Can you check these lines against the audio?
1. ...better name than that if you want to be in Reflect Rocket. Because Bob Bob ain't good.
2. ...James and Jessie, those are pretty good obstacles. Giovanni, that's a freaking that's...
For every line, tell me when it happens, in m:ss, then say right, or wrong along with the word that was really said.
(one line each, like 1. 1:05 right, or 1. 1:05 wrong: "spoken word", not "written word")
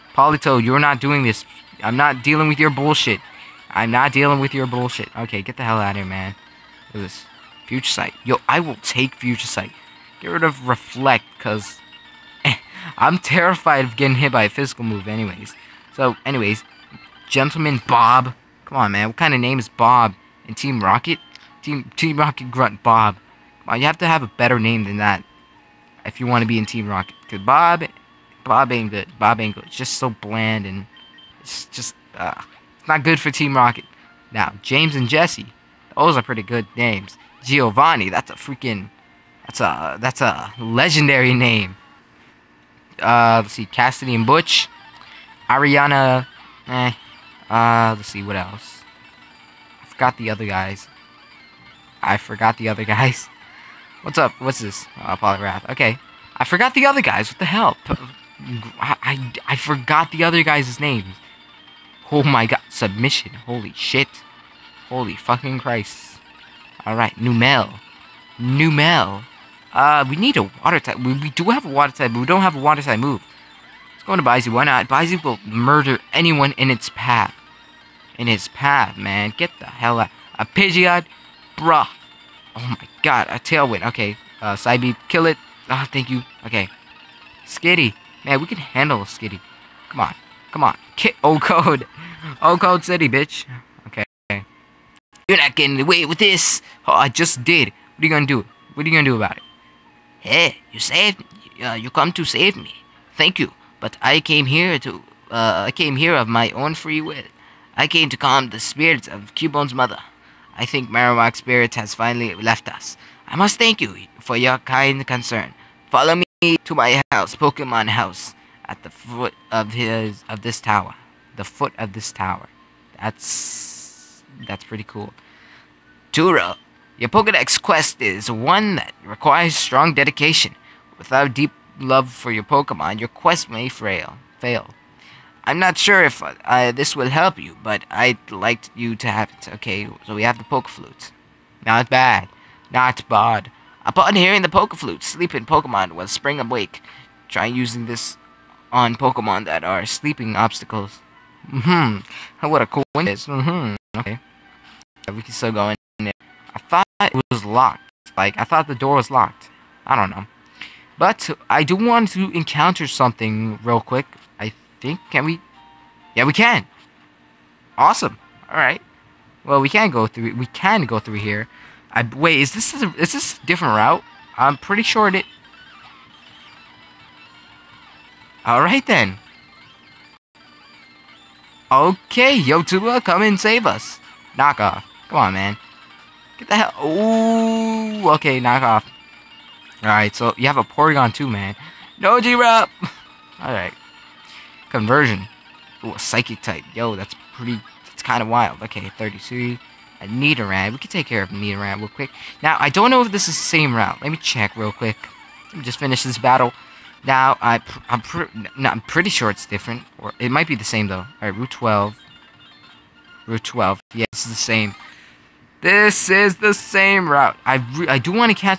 1. 0:24 wrong: "Team", not "Reflect"
2. 0:34 wrong: "names", not "obstacles".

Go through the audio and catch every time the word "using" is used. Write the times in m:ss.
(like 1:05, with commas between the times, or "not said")
2:27.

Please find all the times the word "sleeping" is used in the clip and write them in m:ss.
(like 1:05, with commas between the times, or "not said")
2:25, 2:29.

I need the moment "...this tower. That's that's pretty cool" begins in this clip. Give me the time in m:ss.
2:01.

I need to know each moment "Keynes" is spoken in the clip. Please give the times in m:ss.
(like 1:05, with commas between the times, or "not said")
not said.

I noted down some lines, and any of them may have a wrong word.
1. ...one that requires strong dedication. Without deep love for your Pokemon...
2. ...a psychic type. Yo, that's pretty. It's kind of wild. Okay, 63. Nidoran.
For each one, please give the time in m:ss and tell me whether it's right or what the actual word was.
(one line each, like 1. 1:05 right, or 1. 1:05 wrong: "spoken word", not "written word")
1. 2:08 right
2. 3:15 wrong: "33", not "63".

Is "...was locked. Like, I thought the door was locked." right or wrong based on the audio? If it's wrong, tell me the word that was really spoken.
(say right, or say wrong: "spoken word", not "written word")
right.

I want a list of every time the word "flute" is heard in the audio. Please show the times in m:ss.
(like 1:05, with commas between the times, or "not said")
2:20, 2:24.